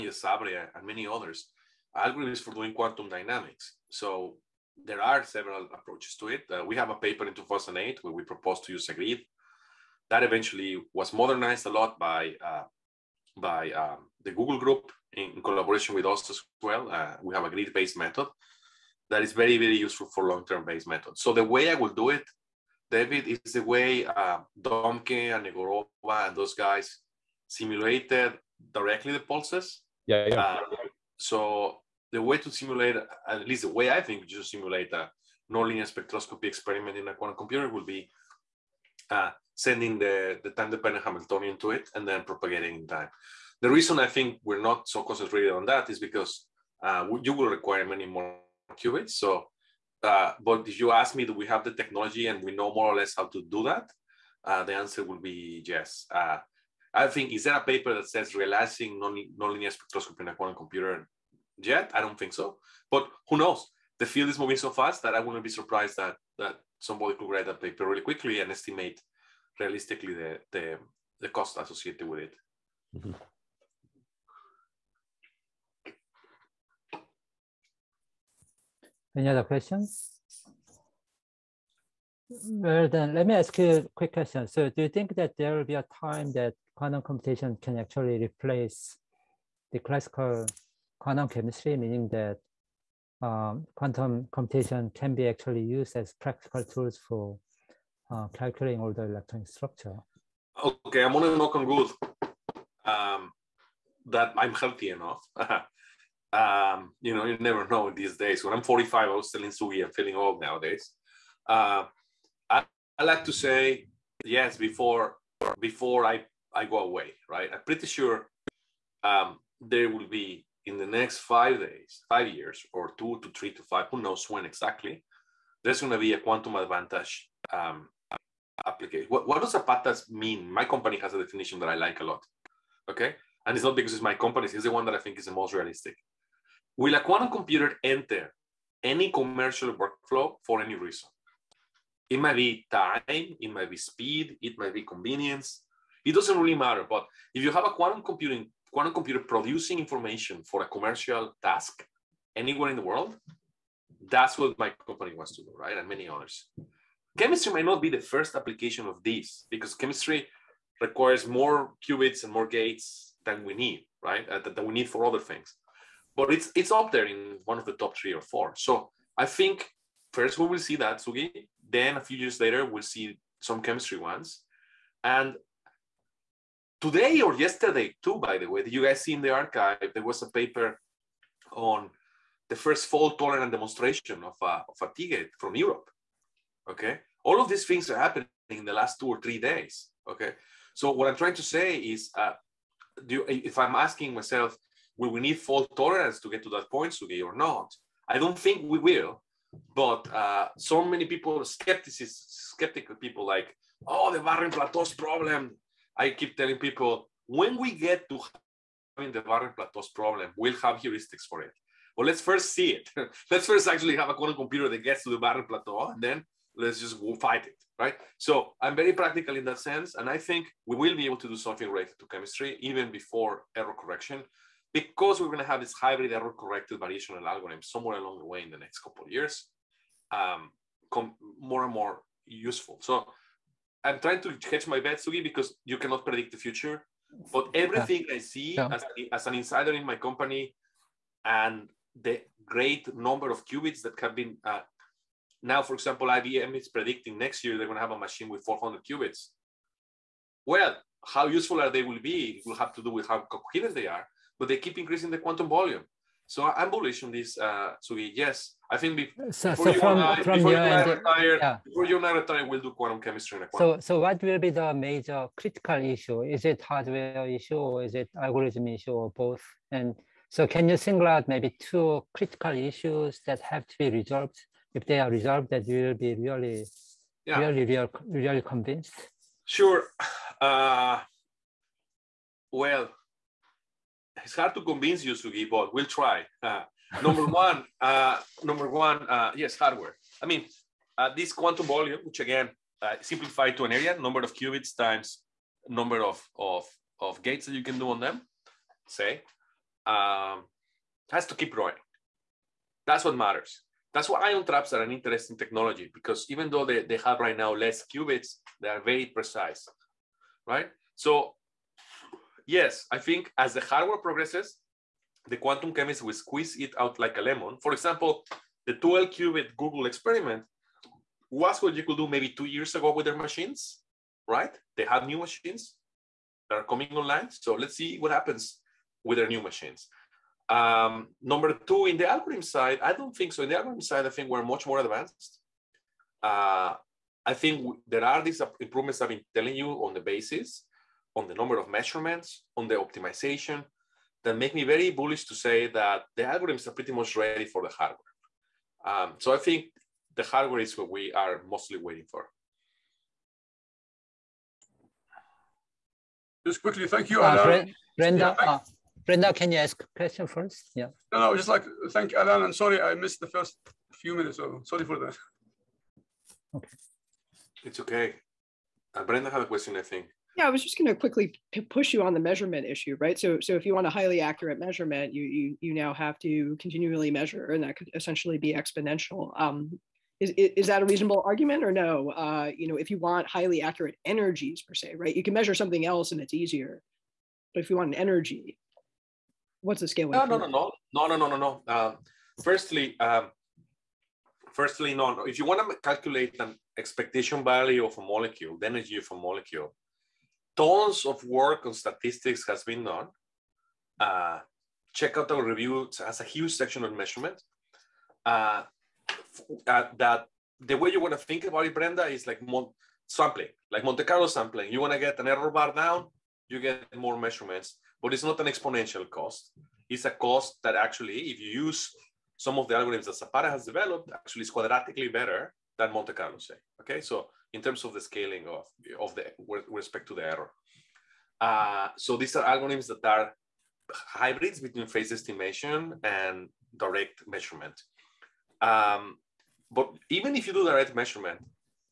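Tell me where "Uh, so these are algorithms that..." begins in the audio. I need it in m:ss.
7:11.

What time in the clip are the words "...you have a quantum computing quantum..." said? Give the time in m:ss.
2:27.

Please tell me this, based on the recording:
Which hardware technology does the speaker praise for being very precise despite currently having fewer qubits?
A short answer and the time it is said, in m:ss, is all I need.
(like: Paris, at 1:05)
Ion traps, at 5:04.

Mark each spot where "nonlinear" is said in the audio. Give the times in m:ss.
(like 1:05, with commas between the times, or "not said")
0:35, 0:59.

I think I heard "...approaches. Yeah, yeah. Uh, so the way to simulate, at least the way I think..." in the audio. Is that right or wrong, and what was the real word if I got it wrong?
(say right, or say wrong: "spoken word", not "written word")
wrong: "pulses", not "approaches".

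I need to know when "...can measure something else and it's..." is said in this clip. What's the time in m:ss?
6:25.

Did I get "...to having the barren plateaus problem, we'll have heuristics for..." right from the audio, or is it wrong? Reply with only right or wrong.
right.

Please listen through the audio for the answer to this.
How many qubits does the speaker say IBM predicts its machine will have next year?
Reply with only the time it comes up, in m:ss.
4:08.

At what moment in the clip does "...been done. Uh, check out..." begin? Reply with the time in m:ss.
6:42.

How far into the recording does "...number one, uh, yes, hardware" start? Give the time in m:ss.
4:48.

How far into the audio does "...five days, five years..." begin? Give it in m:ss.
2:01.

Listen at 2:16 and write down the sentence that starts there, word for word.
Will a quantum computer enter any commercial workflow for any reason?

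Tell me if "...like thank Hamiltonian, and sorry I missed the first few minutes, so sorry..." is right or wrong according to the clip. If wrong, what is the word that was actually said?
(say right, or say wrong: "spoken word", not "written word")
wrong: "Alan", not "Hamiltonian".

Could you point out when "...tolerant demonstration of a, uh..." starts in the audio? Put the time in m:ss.
3:03.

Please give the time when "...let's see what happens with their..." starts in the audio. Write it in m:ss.
5:27.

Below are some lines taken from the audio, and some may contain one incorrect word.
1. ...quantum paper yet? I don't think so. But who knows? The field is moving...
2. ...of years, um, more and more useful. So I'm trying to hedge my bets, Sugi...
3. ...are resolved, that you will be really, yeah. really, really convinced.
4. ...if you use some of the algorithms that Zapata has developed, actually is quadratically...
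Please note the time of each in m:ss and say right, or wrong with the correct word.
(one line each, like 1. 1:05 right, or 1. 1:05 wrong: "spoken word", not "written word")
1. 1:00 wrong: "computer", not "paper"
2. 3:49 right
3. 4:34 right
4. 7:01 right.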